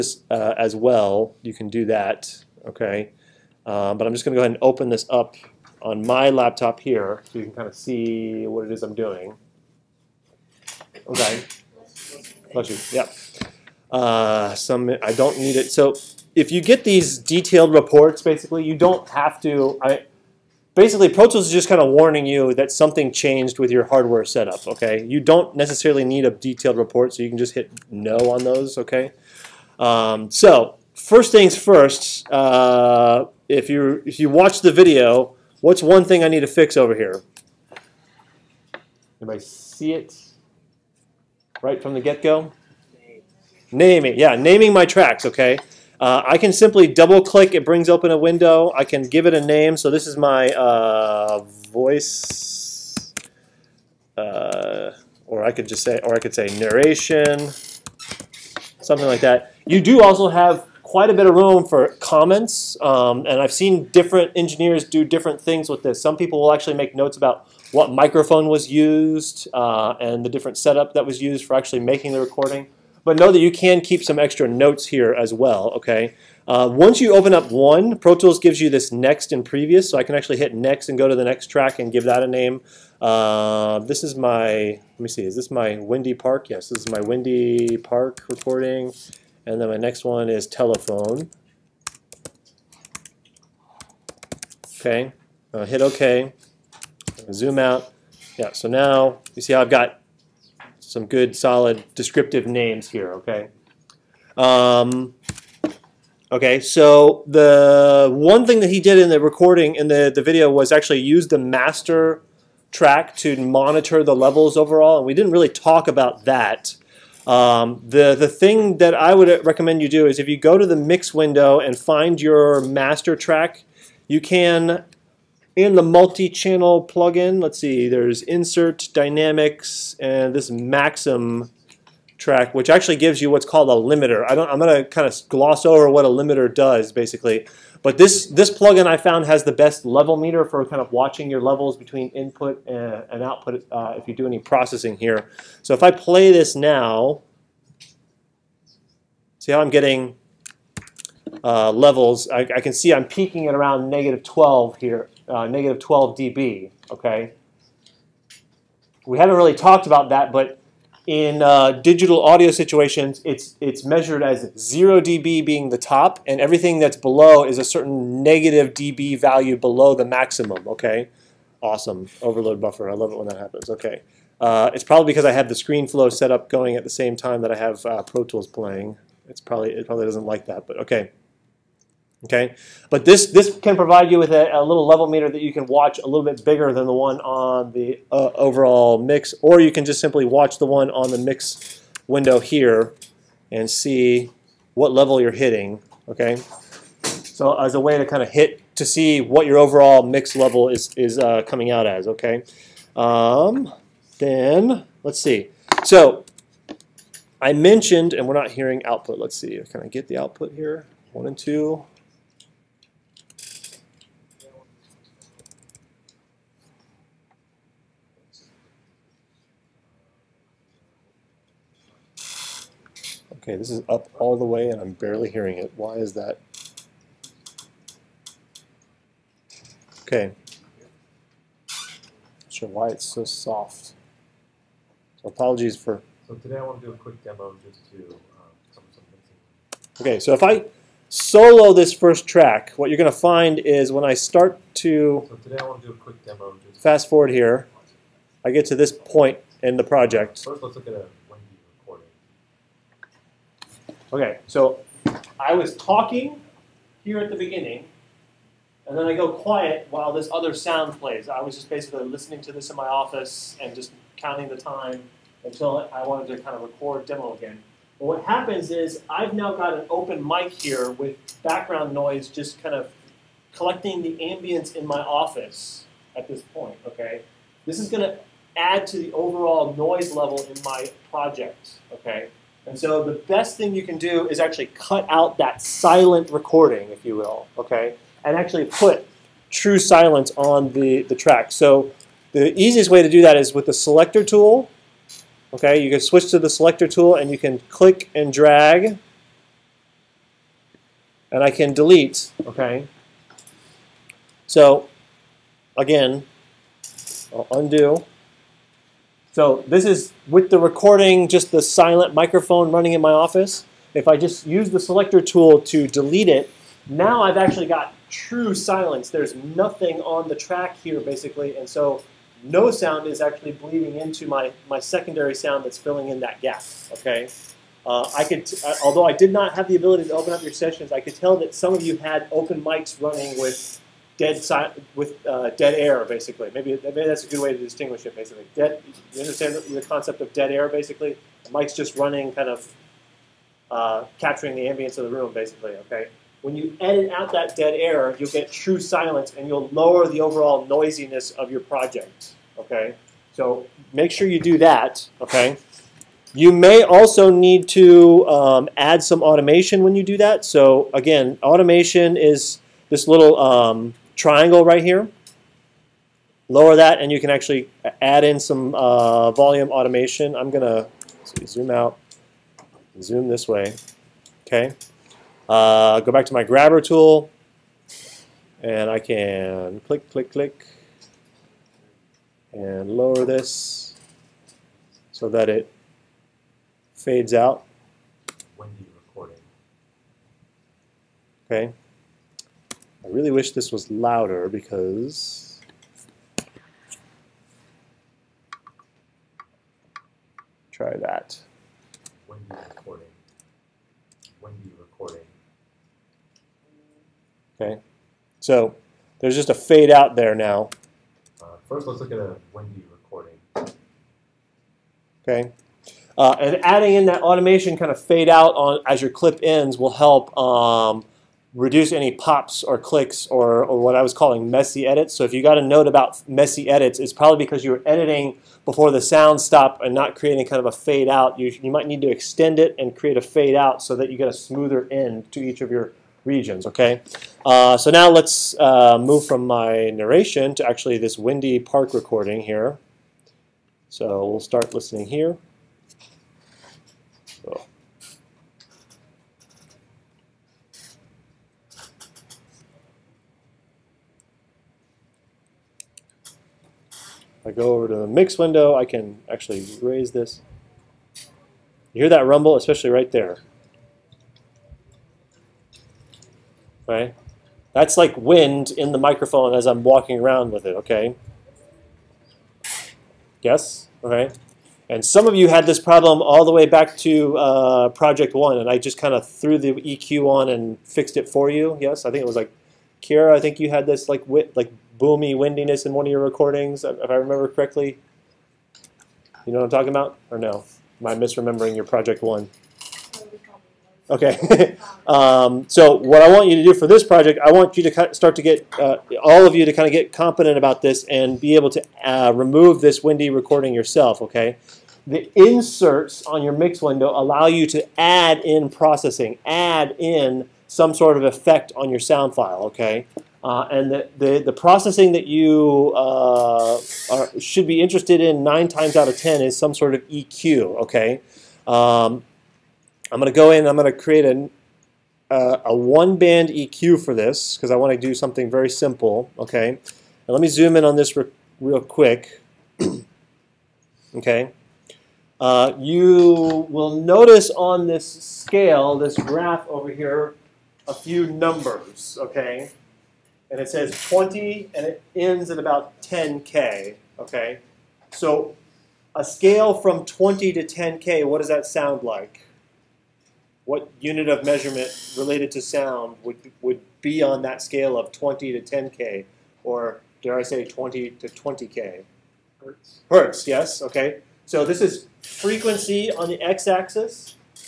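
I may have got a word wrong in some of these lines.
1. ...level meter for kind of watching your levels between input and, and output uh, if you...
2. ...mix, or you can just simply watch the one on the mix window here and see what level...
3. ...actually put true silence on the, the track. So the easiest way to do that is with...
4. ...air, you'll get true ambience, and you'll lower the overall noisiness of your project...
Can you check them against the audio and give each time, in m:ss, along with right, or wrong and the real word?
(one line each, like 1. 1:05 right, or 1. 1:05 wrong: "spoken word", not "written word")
1. 2:19 right
2. 3:09 right
3. 4:48 right
4. 5:47 wrong: "silence", not "ambience".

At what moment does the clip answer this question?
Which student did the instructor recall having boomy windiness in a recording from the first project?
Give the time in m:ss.
8:03.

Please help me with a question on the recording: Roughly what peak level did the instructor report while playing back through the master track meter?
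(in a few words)
-12.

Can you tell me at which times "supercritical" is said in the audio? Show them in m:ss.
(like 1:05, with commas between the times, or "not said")
not said.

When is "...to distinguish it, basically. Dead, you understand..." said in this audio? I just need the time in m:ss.
5:37.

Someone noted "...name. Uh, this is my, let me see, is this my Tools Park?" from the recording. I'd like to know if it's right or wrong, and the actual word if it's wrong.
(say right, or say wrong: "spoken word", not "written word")
wrong: "Windy", not "Tools".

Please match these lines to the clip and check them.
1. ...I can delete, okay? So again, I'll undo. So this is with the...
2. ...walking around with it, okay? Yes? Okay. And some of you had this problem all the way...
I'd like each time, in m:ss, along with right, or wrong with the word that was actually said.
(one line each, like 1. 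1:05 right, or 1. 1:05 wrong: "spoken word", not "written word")
1. 5:01 right
2. 7:49 right.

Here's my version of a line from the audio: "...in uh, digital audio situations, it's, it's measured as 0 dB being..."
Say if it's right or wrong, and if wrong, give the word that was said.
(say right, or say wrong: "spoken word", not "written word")
right.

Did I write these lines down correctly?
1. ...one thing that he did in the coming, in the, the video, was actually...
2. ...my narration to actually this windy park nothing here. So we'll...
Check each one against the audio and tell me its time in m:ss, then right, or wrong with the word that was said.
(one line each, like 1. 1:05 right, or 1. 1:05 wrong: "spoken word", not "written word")
1. 1:48 wrong: "recording", not "coming"
2. 7:19 wrong: "recording", not "nothing".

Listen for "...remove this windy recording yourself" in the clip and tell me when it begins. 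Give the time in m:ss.
8:22.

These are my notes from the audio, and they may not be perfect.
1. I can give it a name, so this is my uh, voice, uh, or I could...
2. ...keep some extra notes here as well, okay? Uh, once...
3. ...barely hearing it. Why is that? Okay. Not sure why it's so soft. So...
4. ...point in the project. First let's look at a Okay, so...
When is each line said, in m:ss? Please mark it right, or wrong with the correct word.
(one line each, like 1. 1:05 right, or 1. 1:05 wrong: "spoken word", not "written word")
1. 0:48 right
2. 1:13 right
3. 3:44 right
4. 4:08 right.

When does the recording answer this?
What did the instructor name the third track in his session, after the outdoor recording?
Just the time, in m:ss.
1:30.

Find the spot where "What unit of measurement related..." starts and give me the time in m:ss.
9:13.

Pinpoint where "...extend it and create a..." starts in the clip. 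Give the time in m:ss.
7:12.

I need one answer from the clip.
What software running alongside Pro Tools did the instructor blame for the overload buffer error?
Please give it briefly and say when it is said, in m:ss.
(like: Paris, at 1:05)
ScreenFlow, at 2:55.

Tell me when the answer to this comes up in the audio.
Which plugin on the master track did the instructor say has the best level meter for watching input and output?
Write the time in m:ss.
2:10.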